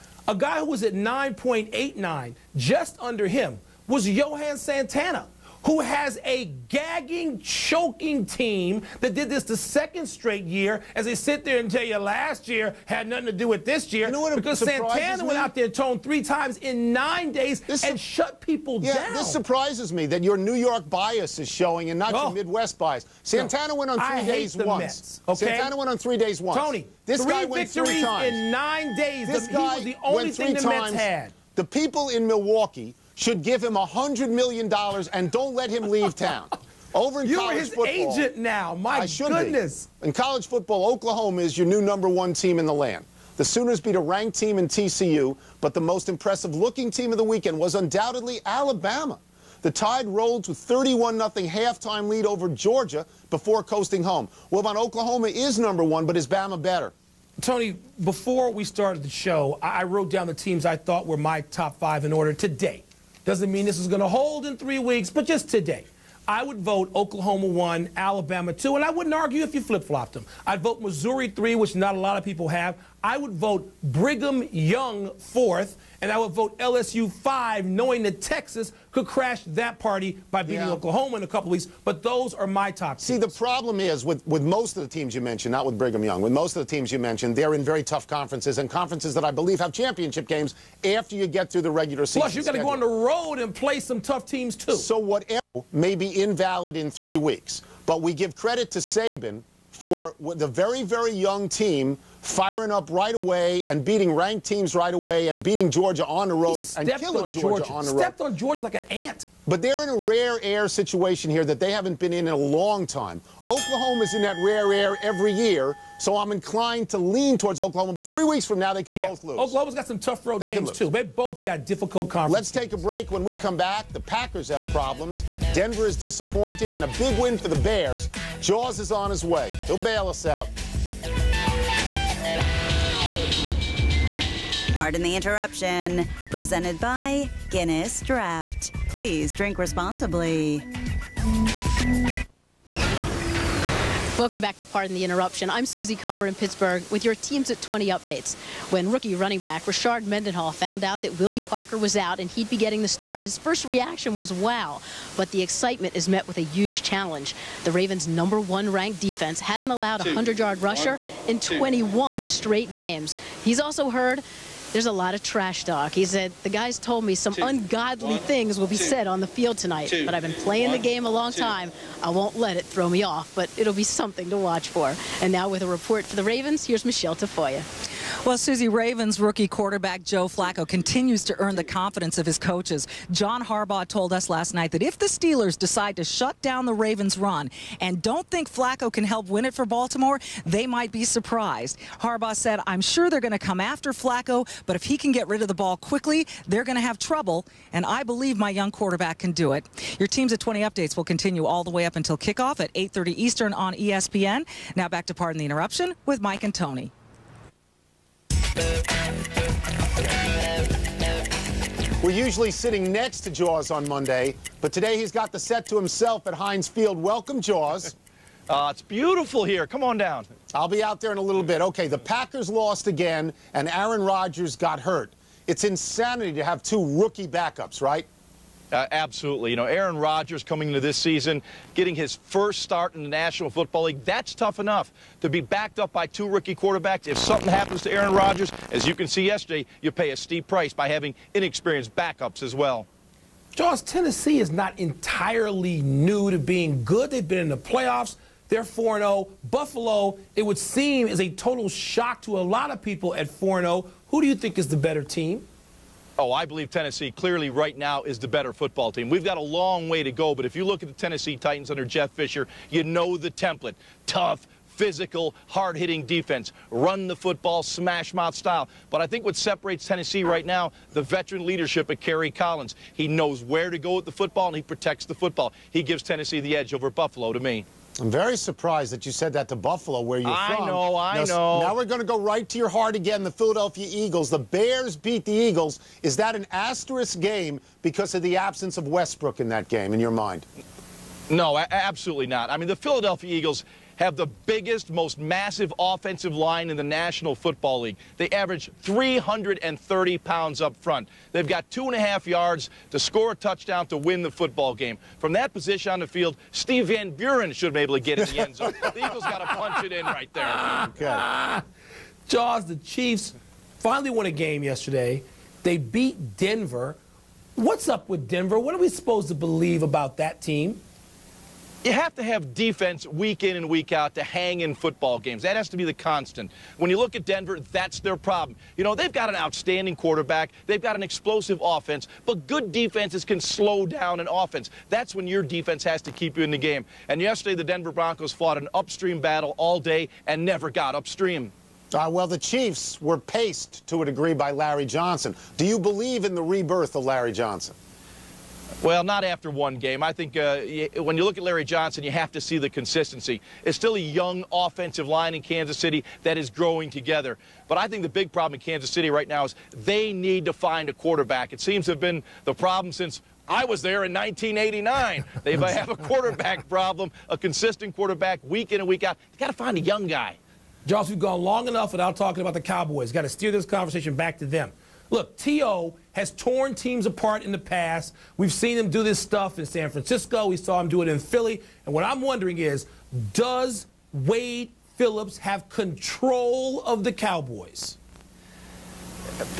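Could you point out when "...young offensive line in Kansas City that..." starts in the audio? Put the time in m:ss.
5:53.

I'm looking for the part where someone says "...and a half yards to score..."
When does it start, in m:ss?
5:01.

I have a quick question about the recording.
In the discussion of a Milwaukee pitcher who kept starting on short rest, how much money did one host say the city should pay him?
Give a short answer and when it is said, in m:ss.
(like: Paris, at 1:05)
$100 million, at 0:33.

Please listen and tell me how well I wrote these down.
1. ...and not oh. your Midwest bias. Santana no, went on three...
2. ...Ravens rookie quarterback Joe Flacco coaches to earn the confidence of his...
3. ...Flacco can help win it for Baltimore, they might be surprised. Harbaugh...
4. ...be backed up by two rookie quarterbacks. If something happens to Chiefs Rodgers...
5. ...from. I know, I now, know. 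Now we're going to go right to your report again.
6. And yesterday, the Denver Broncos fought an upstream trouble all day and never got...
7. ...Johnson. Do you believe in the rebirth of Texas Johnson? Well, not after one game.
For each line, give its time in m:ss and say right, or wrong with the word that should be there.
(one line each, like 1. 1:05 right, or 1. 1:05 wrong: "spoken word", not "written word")
1. 0:21 right
2. 2:58 wrong: "continues", not "coaches"
3. 3:08 right
4. 3:55 wrong: "Aaron", not "Chiefs"
5. 4:40 wrong: "heart", not "report"
6. 5:37 wrong: "battle", not "trouble"
7. 5:44 wrong: "Larry", not "Texas".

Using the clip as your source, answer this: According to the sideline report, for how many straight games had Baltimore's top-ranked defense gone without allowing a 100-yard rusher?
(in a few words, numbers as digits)
21.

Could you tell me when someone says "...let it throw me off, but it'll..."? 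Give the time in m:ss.
2:52.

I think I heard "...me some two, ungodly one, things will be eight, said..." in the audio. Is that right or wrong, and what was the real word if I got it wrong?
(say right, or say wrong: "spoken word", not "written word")
wrong: "two", not "eight".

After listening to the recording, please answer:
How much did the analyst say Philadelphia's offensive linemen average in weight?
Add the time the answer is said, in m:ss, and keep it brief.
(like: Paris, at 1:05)
330 pounds, at 4:58.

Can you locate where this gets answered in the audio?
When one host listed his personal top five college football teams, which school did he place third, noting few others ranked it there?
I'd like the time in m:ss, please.
1:10.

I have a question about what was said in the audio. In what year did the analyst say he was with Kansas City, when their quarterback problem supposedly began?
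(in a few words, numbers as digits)
1989.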